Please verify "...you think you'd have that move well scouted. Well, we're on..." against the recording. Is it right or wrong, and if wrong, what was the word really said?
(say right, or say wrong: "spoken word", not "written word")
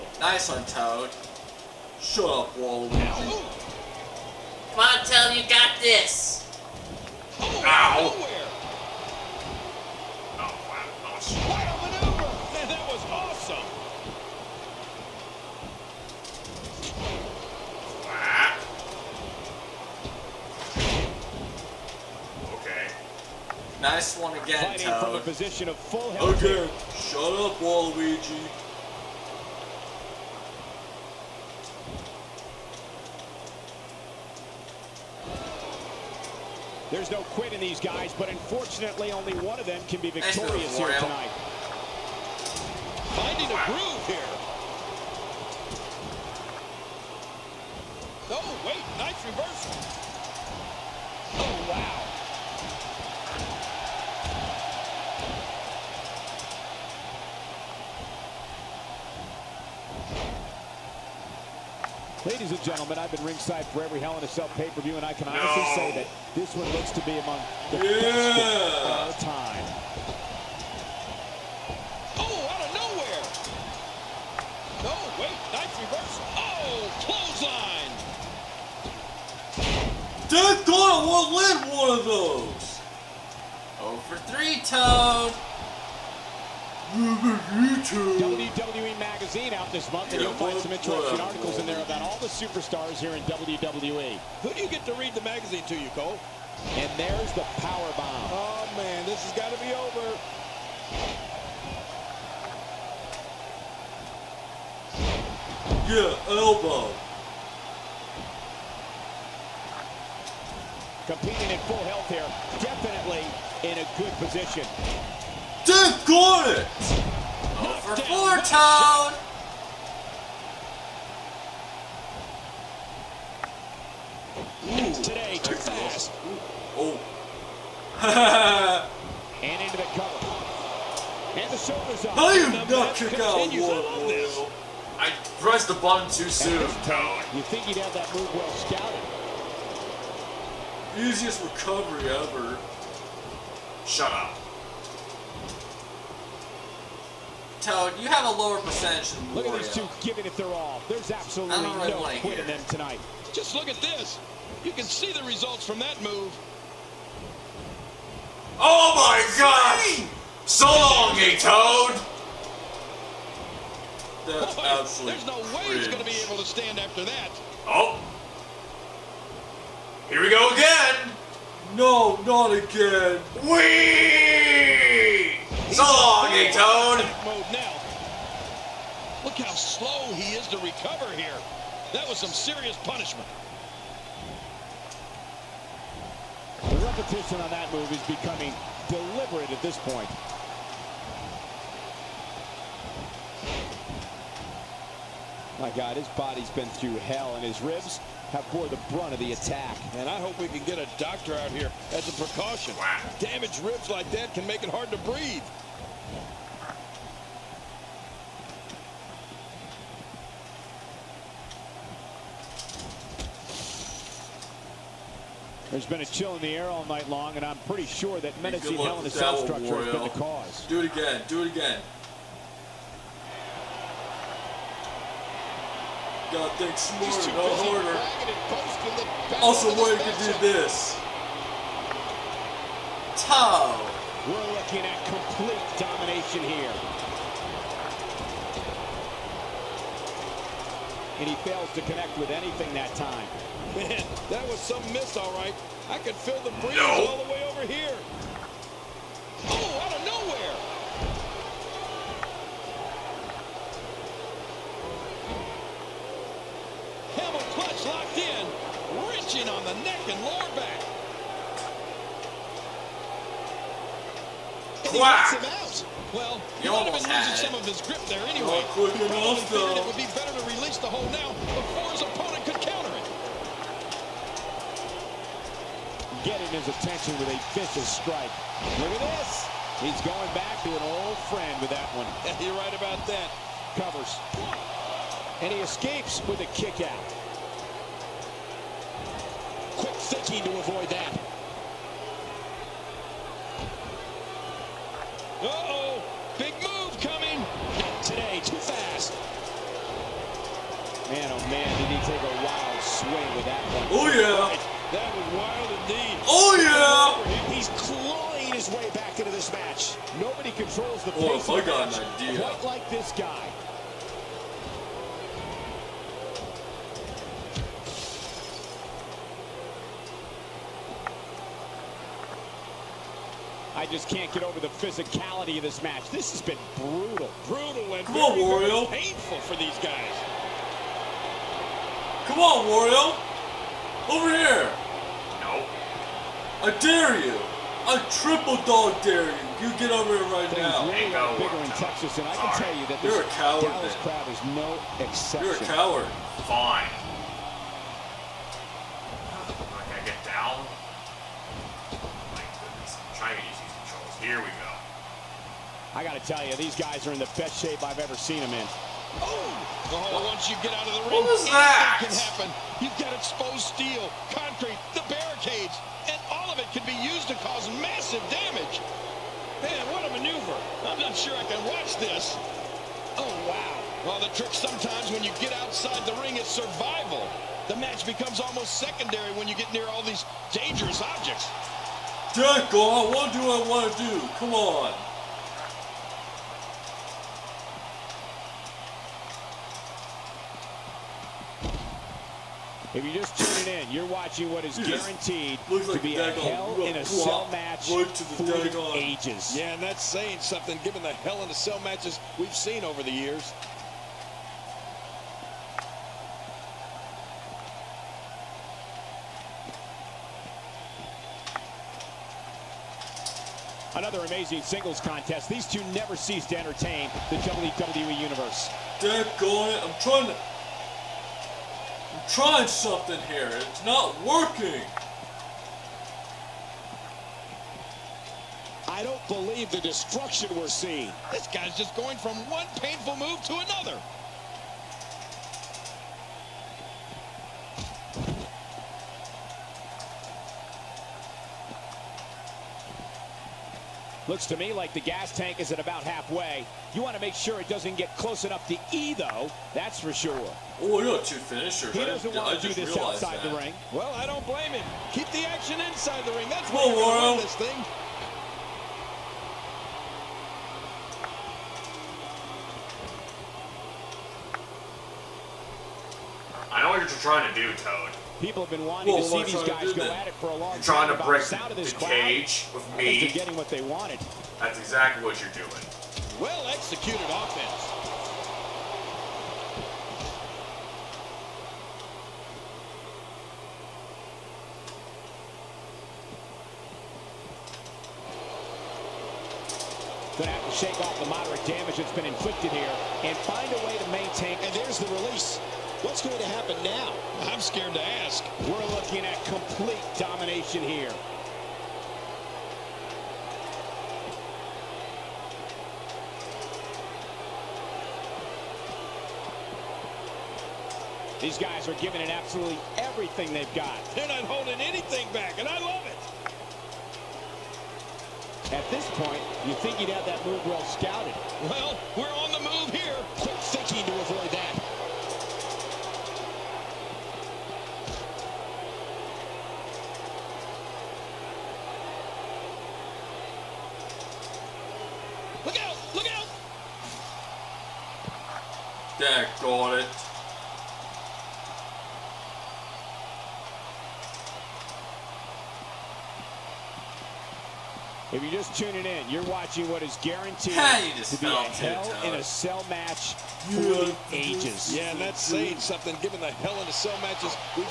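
right.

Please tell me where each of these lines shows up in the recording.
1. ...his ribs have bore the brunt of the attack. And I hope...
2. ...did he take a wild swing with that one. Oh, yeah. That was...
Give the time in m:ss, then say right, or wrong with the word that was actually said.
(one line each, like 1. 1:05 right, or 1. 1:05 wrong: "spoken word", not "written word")
1. 3:17 right
2. 5:01 right.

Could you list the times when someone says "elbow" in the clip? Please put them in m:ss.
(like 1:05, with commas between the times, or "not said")
1:46.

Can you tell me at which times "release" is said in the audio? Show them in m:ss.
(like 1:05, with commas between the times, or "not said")
4:30, 8:15.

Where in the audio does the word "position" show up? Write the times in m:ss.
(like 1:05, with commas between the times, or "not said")
0:25, 1:54.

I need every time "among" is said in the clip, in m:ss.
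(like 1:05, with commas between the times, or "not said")
1:07.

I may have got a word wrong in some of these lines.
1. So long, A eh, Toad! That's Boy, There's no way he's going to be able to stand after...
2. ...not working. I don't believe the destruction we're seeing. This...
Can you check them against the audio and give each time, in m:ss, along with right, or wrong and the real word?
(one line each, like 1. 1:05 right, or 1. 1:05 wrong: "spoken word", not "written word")
1. 2:40 right
2. 7:03 right.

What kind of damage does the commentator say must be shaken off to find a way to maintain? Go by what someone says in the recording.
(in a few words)
moderate damage.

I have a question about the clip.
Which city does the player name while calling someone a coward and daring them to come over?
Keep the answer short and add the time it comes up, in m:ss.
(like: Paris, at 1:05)
Dallas, at 5:43.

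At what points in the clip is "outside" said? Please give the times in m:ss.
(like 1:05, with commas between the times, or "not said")
6:15, 7:32.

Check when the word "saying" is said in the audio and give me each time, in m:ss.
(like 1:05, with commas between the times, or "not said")
6:40, 9:15.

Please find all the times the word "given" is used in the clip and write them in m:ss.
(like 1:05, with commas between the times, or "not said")
6:40, 9:16.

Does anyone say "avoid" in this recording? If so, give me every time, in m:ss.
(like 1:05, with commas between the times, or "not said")
4:50.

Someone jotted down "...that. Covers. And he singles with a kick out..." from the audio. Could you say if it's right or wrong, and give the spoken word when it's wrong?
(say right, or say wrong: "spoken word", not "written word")
wrong: "escapes", not "singles".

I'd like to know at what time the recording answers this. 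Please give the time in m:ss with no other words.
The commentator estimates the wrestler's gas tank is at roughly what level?
7:26.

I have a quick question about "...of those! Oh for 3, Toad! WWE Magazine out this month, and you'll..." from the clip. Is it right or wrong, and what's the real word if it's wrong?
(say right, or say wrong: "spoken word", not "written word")
right.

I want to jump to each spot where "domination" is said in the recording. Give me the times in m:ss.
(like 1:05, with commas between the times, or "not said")
3:55, 8:20.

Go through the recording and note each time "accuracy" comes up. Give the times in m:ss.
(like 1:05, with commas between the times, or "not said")
not said.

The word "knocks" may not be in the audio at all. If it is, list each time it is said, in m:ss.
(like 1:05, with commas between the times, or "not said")
4:24.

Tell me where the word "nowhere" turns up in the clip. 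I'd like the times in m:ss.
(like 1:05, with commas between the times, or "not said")
0:10, 1:12.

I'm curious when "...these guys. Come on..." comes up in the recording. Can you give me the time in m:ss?
5:29.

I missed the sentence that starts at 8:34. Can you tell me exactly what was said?
They're not holding anything back, and I love it.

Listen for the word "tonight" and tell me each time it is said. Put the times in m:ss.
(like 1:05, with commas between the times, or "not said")
0:40, 2:32.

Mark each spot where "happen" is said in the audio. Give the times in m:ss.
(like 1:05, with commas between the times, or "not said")
6:02, 8:16.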